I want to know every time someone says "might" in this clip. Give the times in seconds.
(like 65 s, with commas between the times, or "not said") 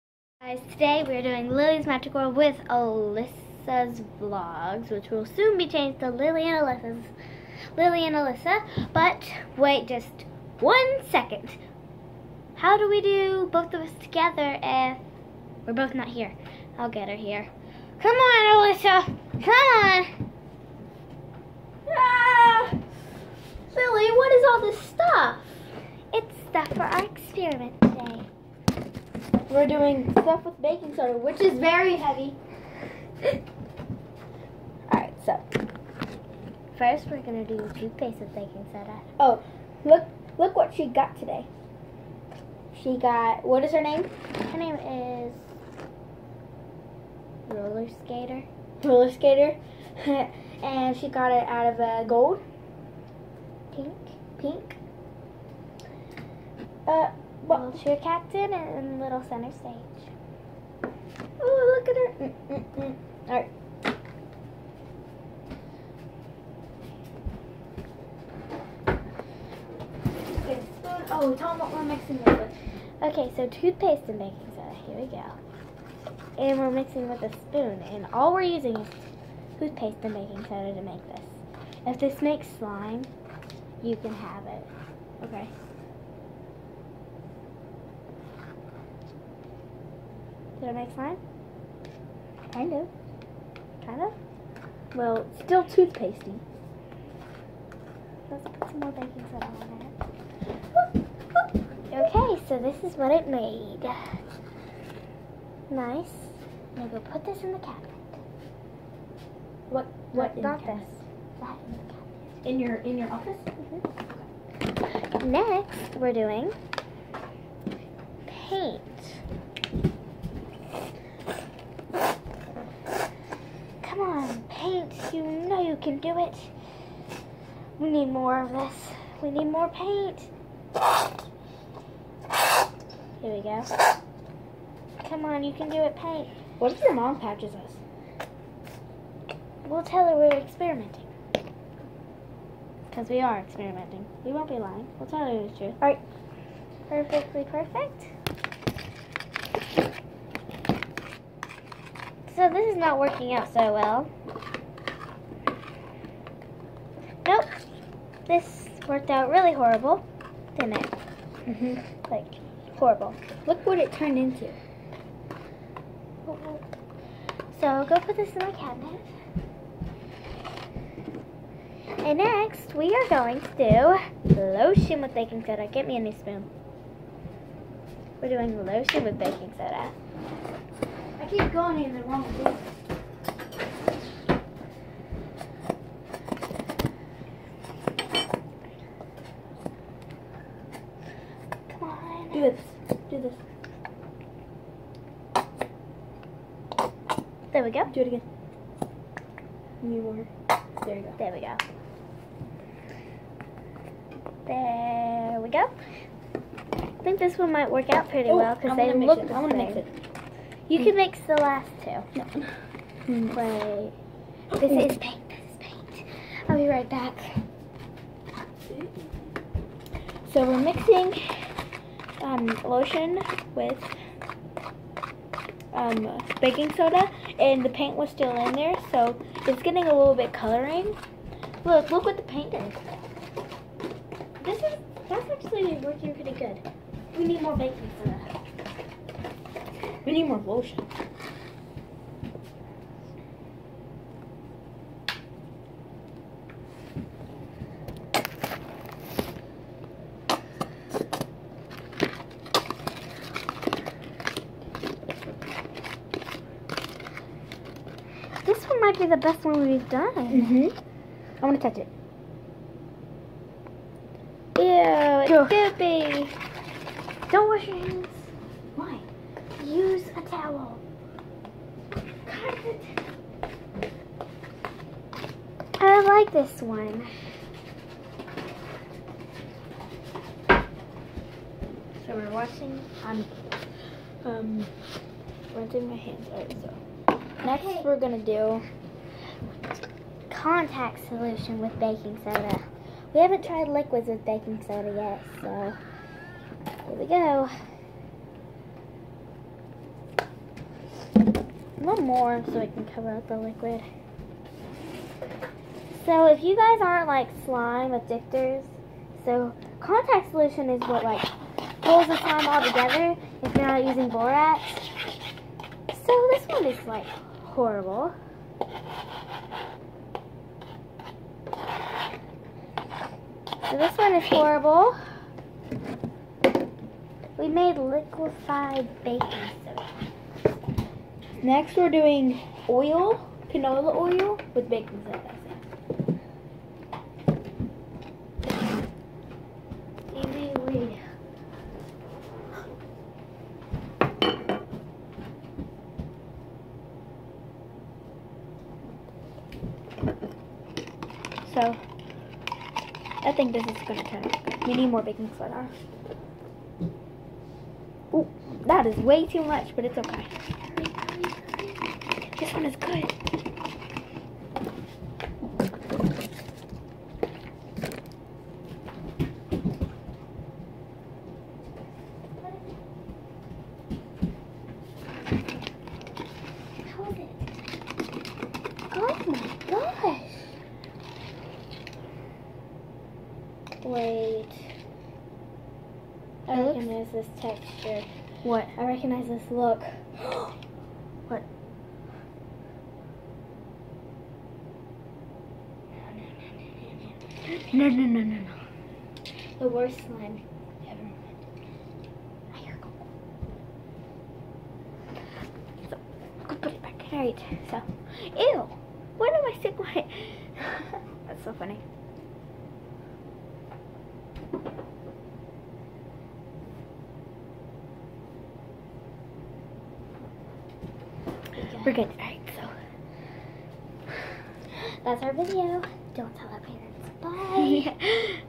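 207 s, 258 s.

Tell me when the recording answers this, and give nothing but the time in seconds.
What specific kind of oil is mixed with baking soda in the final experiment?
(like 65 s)
333 s.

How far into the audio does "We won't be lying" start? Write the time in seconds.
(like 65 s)
144 s.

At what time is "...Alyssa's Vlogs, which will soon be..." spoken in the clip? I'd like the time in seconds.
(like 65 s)
2 s.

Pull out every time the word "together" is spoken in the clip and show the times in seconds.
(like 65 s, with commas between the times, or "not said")
14 s, 312 s.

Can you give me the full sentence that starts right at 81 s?
If this makes slime, you can have it.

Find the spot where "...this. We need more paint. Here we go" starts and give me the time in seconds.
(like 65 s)
128 s.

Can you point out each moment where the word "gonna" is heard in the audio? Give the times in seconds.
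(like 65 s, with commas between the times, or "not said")
287 s, 353 s.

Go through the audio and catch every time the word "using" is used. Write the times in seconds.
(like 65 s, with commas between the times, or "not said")
78 s, 313 s.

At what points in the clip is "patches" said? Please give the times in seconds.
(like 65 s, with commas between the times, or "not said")
137 s.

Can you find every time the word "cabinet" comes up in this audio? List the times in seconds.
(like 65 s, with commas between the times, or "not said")
107 s, 111 s, 168 s.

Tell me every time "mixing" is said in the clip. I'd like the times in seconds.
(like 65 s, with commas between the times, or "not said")
71 s, 76 s, 220 s.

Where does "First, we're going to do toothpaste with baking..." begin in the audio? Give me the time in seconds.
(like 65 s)
36 s.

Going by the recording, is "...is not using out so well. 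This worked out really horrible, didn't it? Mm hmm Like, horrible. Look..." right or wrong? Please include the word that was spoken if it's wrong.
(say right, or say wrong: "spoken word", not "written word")
wrong: "working", not "using".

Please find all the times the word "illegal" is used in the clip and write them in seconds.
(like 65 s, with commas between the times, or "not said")
not said.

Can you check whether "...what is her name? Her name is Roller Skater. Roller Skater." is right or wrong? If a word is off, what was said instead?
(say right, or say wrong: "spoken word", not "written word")
right.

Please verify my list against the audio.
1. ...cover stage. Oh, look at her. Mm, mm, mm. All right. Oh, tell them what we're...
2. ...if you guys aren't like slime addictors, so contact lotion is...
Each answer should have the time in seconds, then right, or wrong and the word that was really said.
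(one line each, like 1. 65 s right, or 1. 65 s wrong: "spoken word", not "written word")
1. 59 s wrong: "center", not "cover"
2. 306 s wrong: "solution", not "lotion".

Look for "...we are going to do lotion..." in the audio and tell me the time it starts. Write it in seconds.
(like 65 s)
172 s.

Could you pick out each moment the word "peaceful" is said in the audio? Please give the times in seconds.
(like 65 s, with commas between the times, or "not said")
not said.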